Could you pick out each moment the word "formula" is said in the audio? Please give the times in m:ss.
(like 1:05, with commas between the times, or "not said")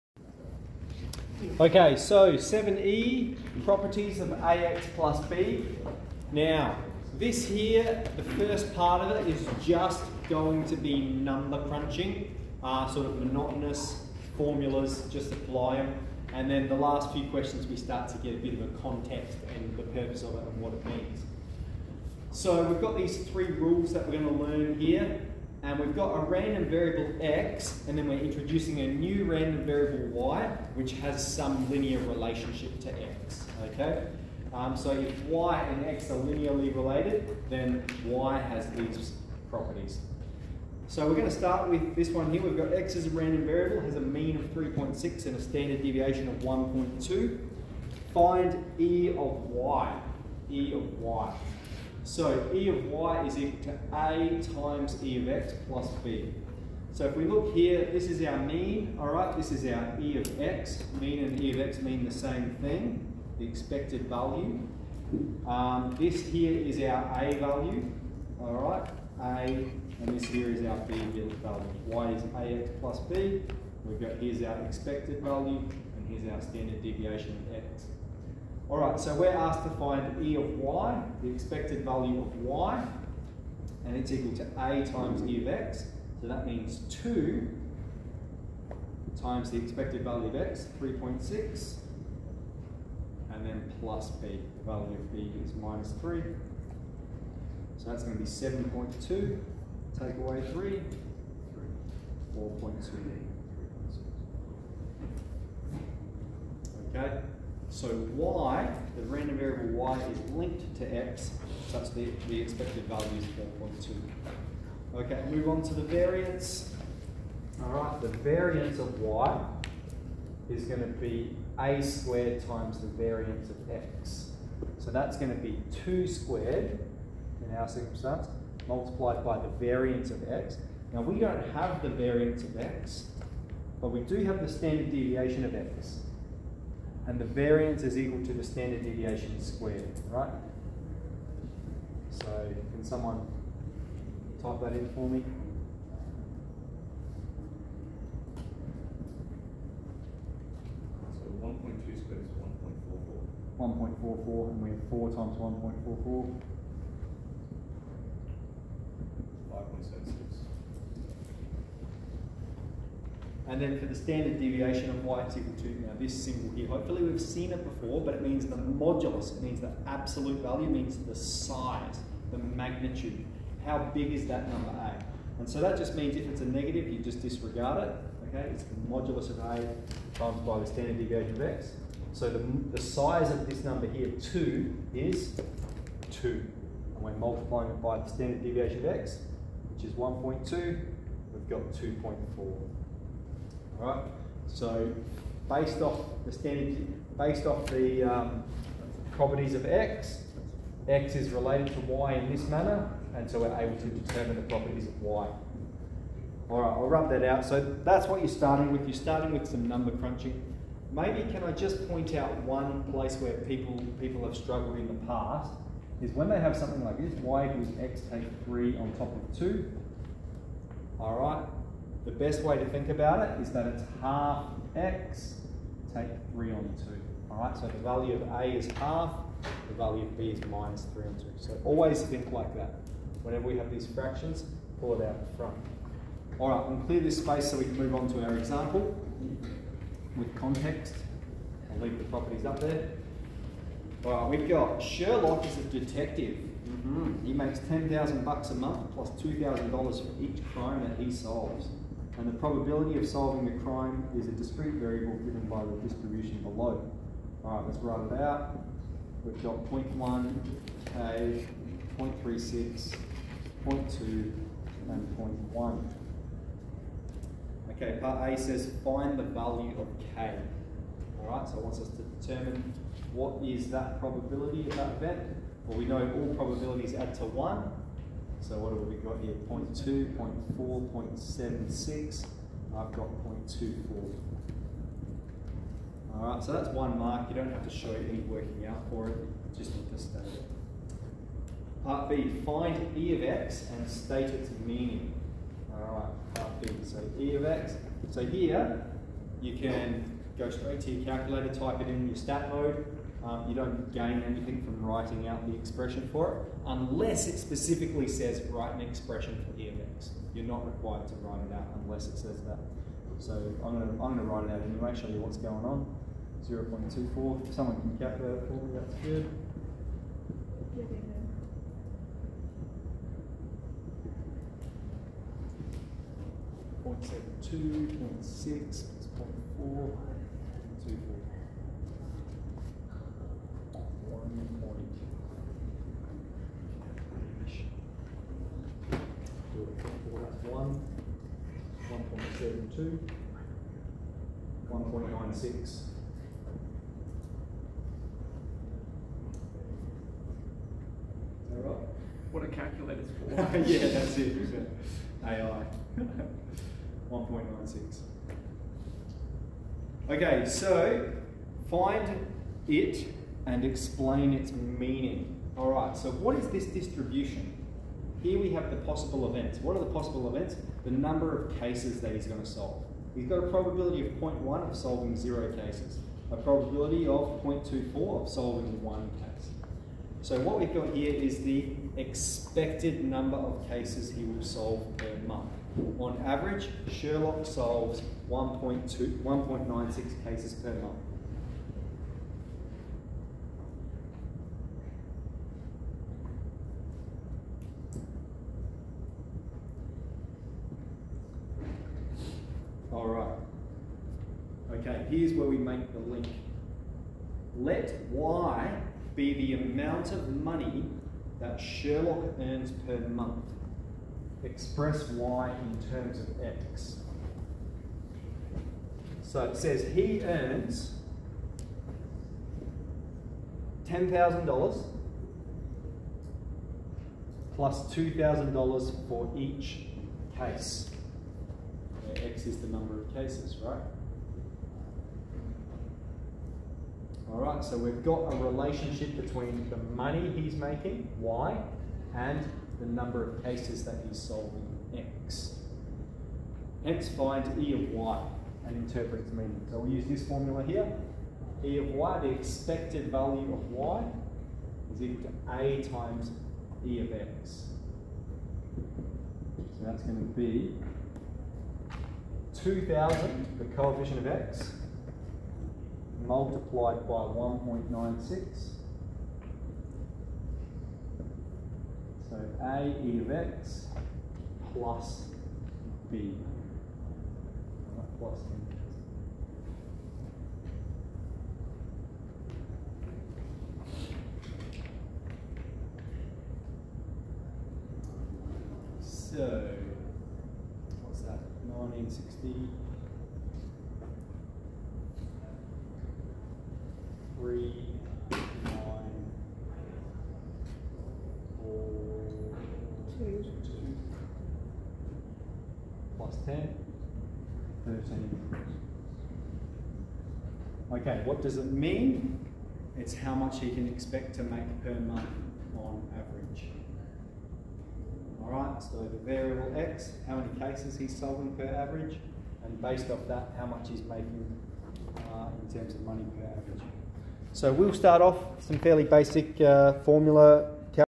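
0:14, 7:30, 8:50.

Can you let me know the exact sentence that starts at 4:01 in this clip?
I'll leave the properties up there.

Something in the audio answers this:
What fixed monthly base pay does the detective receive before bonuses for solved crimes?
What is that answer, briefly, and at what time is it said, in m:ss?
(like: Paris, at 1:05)
$10,000, at 4:07.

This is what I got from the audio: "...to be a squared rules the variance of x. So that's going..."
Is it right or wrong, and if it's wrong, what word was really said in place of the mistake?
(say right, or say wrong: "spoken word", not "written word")
wrong: "times", not "rules".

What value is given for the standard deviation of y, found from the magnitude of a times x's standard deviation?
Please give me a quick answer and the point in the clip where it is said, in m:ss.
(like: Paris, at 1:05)
2.4, at 3:11.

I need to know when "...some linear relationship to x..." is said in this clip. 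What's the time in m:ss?
0:31.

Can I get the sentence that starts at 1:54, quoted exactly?
Okay, move on to the variance.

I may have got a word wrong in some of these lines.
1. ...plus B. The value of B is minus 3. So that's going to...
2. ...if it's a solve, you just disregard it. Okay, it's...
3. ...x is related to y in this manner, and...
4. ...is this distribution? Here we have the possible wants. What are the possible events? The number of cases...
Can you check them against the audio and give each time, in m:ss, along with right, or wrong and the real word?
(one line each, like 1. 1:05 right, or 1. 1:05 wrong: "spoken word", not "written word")
1. 1:33 right
2. 2:56 wrong: "negative", not "solve"
3. 3:20 right
4. 6:06 wrong: "events", not "wants".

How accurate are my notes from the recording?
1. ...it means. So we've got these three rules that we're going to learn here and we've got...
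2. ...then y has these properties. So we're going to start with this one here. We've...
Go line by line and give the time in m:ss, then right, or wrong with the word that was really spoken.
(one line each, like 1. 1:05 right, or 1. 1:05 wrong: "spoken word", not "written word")
1. 0:20 right
2. 0:37 right.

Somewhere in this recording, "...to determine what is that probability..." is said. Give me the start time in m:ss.
4:31.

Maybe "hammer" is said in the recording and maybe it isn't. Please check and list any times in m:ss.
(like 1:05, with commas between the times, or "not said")
not said.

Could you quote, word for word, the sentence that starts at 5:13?
So I'm going to, I'm going to write it out anyway, show you what's going on.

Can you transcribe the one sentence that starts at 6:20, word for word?
So what we've got here is the expected number of cases he will solve per month.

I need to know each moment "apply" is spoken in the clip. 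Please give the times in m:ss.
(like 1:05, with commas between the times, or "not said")
0:15.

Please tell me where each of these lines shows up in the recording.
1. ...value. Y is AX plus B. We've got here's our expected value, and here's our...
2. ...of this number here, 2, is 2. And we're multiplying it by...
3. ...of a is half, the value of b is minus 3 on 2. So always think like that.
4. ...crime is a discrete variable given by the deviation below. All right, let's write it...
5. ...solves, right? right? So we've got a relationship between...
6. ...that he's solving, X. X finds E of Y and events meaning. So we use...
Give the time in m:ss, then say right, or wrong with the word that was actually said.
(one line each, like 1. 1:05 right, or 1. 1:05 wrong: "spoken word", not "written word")
1. 1:10 right
2. 3:03 right
3. 3:48 right
4. 4:13 wrong: "distribution", not "deviation"
5. 7:13 wrong: "cases", not "solves"
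6. 7:23 wrong: "interprets", not "events".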